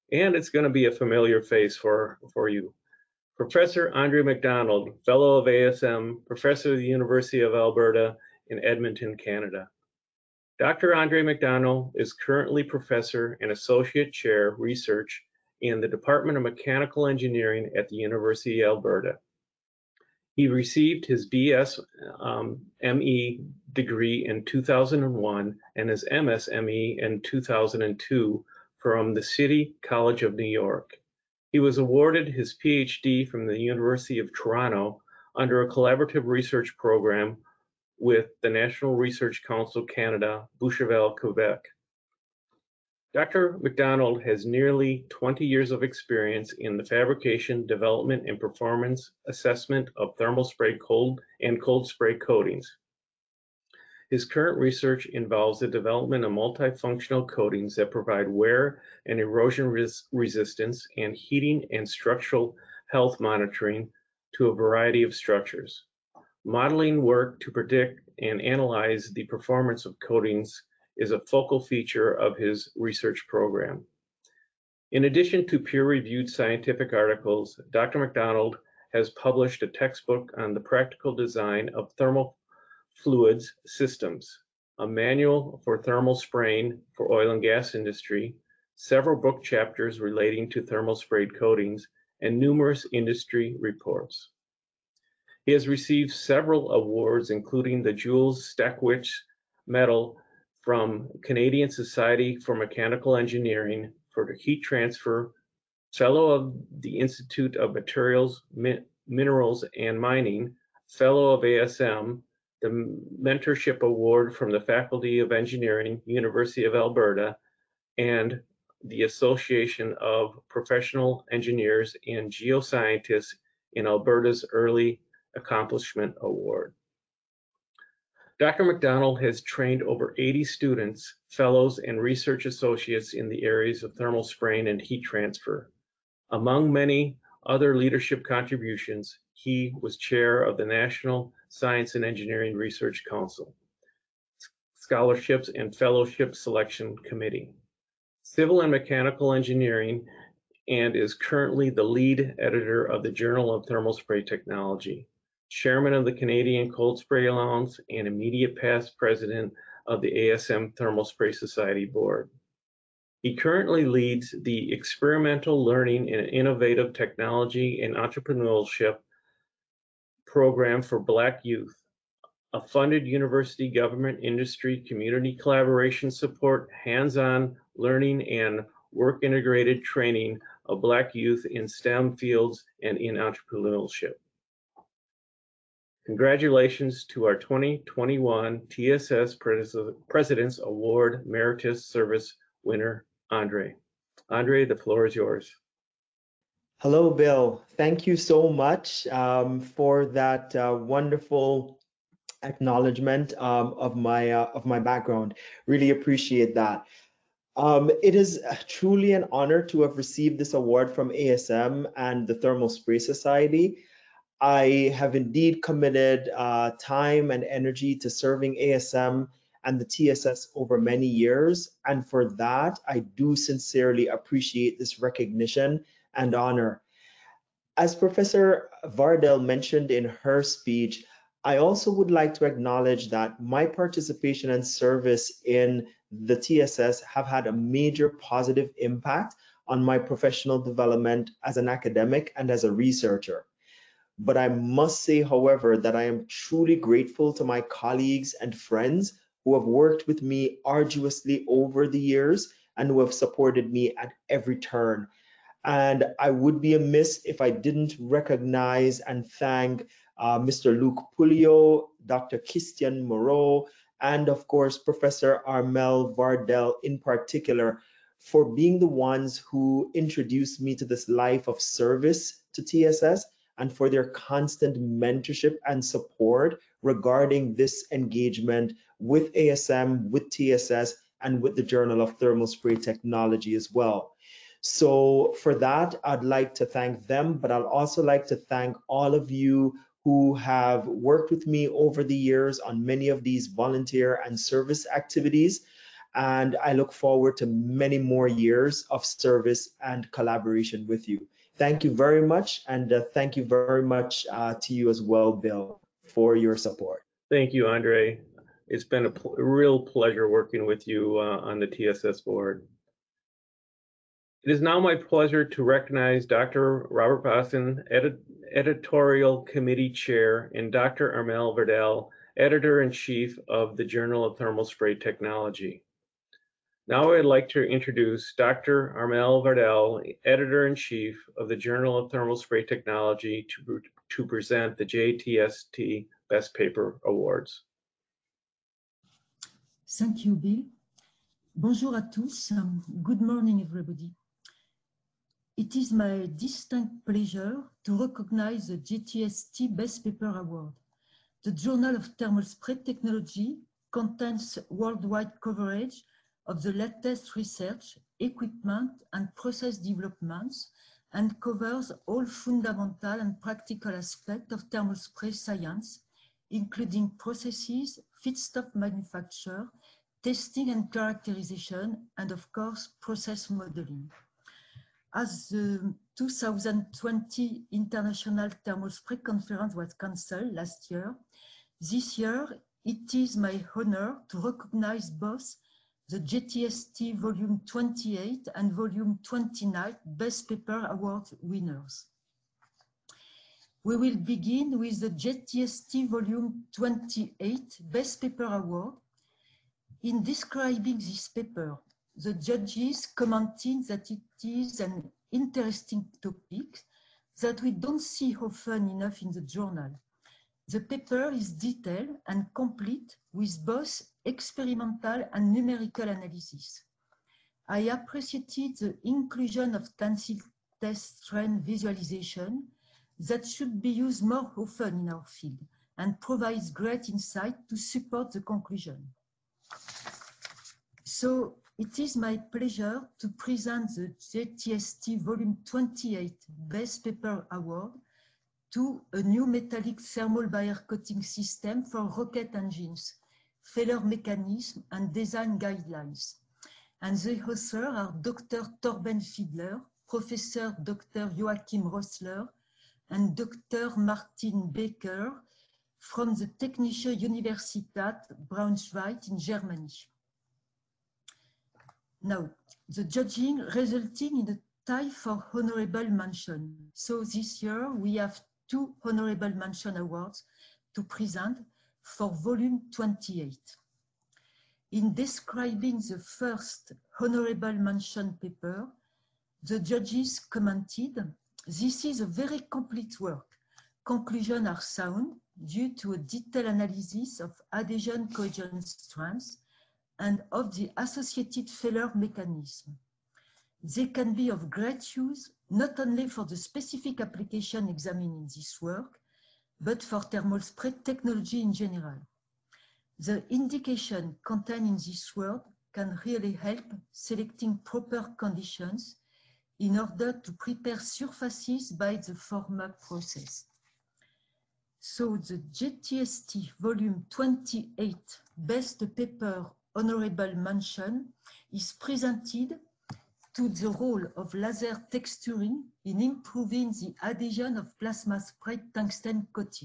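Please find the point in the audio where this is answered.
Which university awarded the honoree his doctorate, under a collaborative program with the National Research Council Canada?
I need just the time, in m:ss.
0:33.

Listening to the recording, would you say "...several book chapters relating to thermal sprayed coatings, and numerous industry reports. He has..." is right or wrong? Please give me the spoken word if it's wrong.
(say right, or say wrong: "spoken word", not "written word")
right.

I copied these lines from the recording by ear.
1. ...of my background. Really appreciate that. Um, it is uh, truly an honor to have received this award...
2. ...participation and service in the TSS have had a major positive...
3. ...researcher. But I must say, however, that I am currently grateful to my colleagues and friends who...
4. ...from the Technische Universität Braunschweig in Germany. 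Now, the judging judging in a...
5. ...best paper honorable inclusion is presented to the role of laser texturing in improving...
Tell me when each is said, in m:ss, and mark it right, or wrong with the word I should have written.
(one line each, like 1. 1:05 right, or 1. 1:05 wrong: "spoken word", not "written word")
1. 3:24 right
2. 3:53 right
3. 4:02 wrong: "truly", not "currently"
4. 7:35 wrong: "resulting", not "judging"
5. 8:38 wrong: "mention", not "inclusion".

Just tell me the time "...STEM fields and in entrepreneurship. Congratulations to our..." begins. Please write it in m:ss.
3:01.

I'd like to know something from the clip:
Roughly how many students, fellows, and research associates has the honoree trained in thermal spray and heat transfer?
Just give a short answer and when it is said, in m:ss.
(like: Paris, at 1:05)
over 80, at 2:09.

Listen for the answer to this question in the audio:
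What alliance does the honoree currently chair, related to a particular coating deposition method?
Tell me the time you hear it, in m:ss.
2:36.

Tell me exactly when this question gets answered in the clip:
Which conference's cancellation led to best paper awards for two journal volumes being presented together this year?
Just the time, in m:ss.
6:16.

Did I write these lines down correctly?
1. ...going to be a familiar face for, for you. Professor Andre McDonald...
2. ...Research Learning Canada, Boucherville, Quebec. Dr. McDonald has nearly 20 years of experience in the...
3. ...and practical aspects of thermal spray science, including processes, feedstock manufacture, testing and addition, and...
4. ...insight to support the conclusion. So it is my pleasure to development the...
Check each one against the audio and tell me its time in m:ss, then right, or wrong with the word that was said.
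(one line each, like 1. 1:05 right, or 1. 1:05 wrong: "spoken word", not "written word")
1. 0:00 right
2. 0:38 wrong: "Council", not "Learning"
3. 6:03 wrong: "characterization", not "addition"
4. 7:07 wrong: "present", not "development".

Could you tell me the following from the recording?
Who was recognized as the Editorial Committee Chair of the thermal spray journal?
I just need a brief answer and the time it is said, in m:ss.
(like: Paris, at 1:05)
Robert Boston, at 5:16.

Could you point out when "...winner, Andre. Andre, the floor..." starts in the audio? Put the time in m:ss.
3:12.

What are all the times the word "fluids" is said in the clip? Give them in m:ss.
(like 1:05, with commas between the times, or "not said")
1:23.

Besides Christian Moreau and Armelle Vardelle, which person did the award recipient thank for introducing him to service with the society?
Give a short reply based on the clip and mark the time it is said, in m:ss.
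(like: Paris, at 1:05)
Luke Pouliot, at 4:20.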